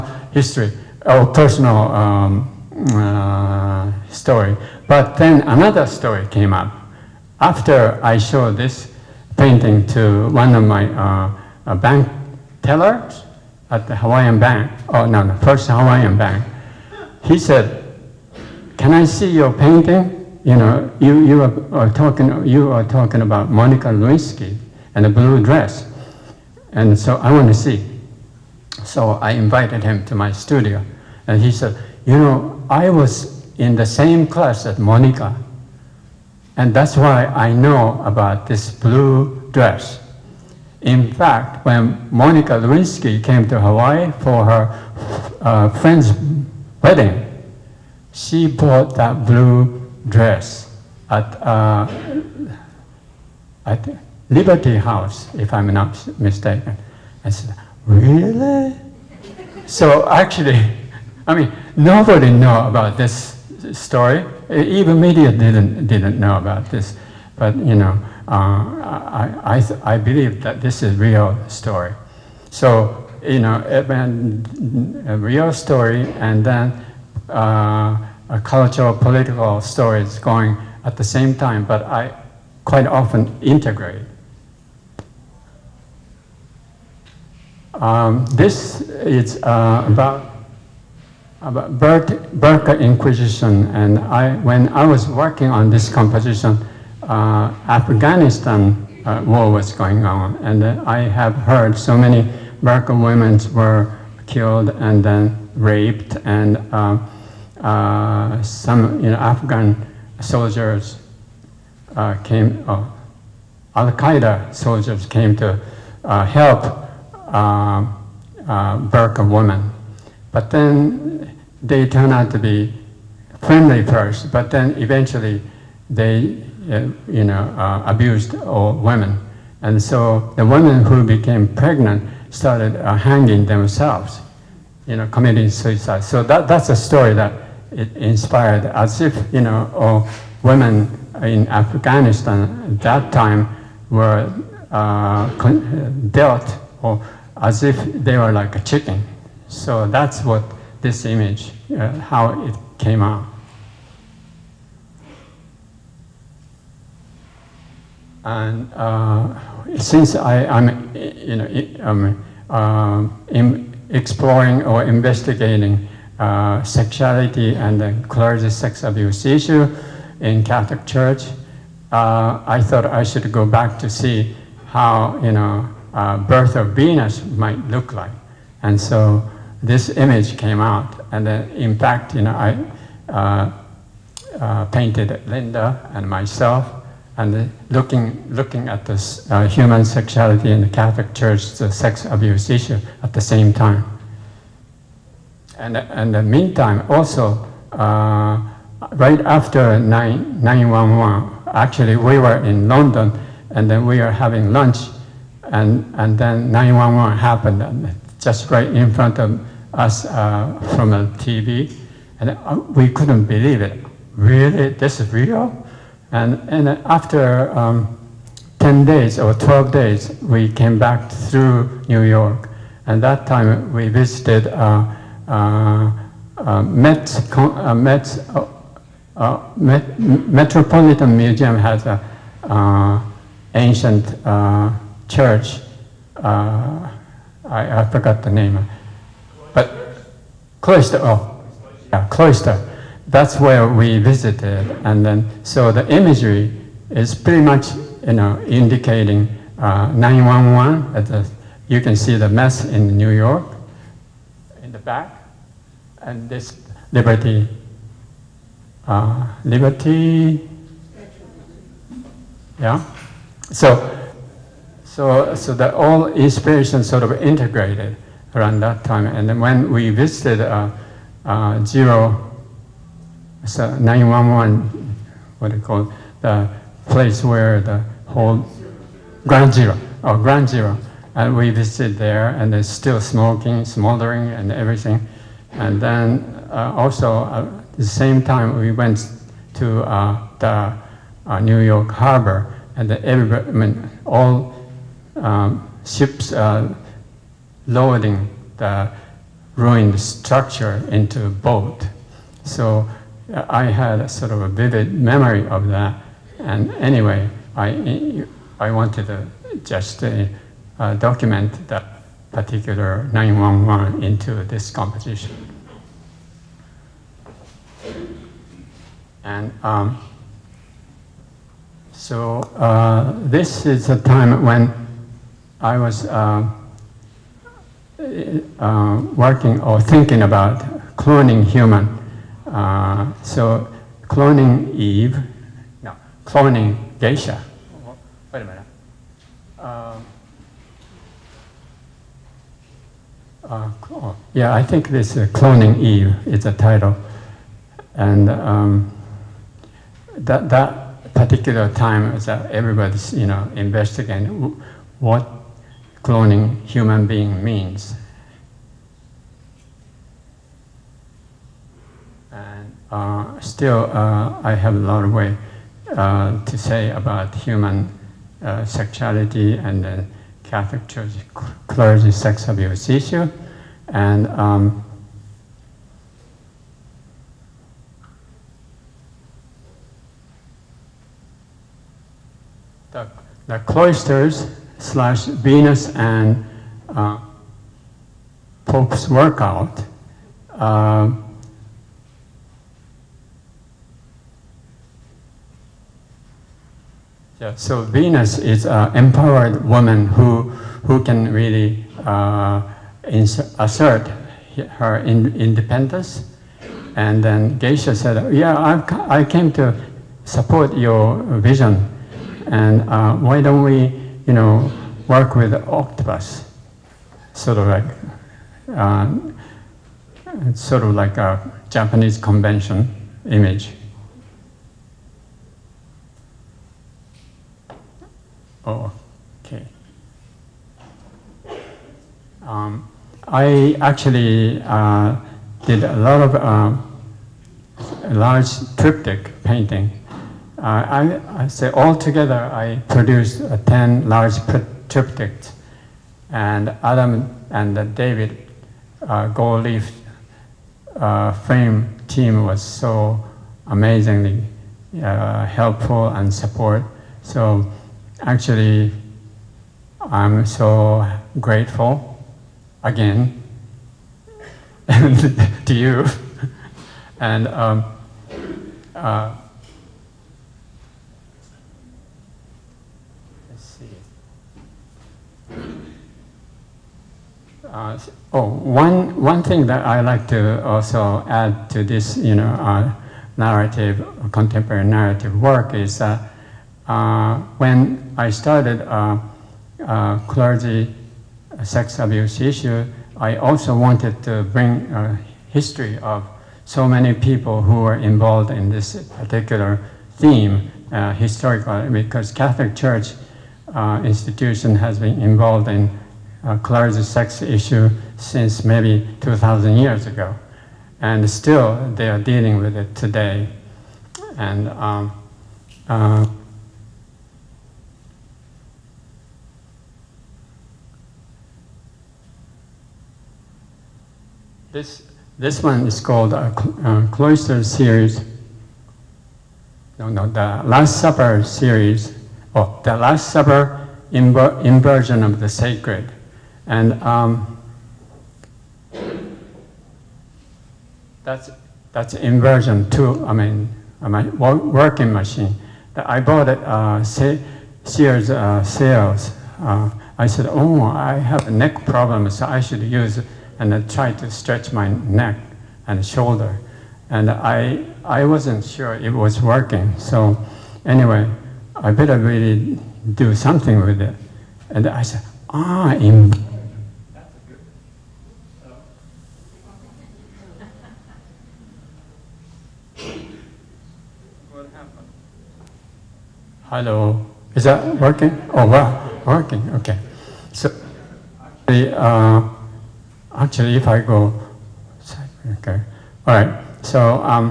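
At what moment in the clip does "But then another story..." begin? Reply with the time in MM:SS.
00:04.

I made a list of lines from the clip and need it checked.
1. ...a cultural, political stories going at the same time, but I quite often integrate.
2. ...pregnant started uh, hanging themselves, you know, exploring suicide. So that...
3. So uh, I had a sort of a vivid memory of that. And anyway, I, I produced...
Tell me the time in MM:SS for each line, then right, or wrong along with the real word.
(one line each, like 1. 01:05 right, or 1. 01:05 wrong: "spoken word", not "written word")
1. 01:18 right
2. 02:11 wrong: "committing", not "exploring"
3. 05:02 wrong: "wanted", not "produced".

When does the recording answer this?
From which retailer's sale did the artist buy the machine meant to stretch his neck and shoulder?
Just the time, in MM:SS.
09:07.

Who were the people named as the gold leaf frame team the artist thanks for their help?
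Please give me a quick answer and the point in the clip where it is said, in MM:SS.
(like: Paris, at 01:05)
Adam and David, at 07:26.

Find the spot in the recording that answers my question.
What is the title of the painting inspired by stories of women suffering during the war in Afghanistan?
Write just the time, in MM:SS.
01:32.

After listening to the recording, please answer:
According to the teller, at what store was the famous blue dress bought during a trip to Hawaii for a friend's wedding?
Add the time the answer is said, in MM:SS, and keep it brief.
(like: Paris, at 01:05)
Liberty House, at 00:54.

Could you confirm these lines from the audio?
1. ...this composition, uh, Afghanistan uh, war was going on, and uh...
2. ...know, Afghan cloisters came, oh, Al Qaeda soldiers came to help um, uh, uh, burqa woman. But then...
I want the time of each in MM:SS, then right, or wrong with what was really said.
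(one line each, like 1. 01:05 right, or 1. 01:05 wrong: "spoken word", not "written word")
1. 01:35 right
2. 01:49 wrong: "soldiers", not "cloisters".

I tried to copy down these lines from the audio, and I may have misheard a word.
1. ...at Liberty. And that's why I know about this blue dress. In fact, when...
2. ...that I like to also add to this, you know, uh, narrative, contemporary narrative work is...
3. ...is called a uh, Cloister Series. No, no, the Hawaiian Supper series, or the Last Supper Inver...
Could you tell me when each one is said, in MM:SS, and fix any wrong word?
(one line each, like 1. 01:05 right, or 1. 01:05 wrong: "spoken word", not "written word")
1. 00:34 wrong: "Monica", not "Liberty"
2. 07:59 right
3. 08:45 wrong: "Last", not "Hawaiian".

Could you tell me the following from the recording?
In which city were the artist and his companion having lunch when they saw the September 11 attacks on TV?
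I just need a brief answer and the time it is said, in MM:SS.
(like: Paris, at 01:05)
London, at 03:22.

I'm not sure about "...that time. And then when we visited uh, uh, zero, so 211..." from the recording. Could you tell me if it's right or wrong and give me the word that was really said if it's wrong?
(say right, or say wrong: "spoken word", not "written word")
wrong: "911", not "211".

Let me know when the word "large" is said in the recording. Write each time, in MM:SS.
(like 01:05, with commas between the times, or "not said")
07:18, 07:24.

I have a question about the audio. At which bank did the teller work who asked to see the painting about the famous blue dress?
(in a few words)
First Hawaiian Bank.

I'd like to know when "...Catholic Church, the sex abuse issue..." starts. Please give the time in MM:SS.
03:10.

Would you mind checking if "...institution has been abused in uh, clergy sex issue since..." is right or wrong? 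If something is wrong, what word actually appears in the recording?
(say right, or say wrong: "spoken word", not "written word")
wrong: "involved", not "abused".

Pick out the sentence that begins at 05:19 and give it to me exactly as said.
And um, so uh, this is a time when I was uh, uh, working or thinking about cloning human.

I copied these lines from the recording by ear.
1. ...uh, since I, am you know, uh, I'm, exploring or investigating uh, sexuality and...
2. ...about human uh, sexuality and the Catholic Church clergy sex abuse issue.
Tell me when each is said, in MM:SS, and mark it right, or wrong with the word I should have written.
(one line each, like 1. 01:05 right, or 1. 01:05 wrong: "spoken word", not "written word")
1. 02:38 right
2. 06:06 right.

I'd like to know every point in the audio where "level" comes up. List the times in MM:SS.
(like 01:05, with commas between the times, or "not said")
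not said.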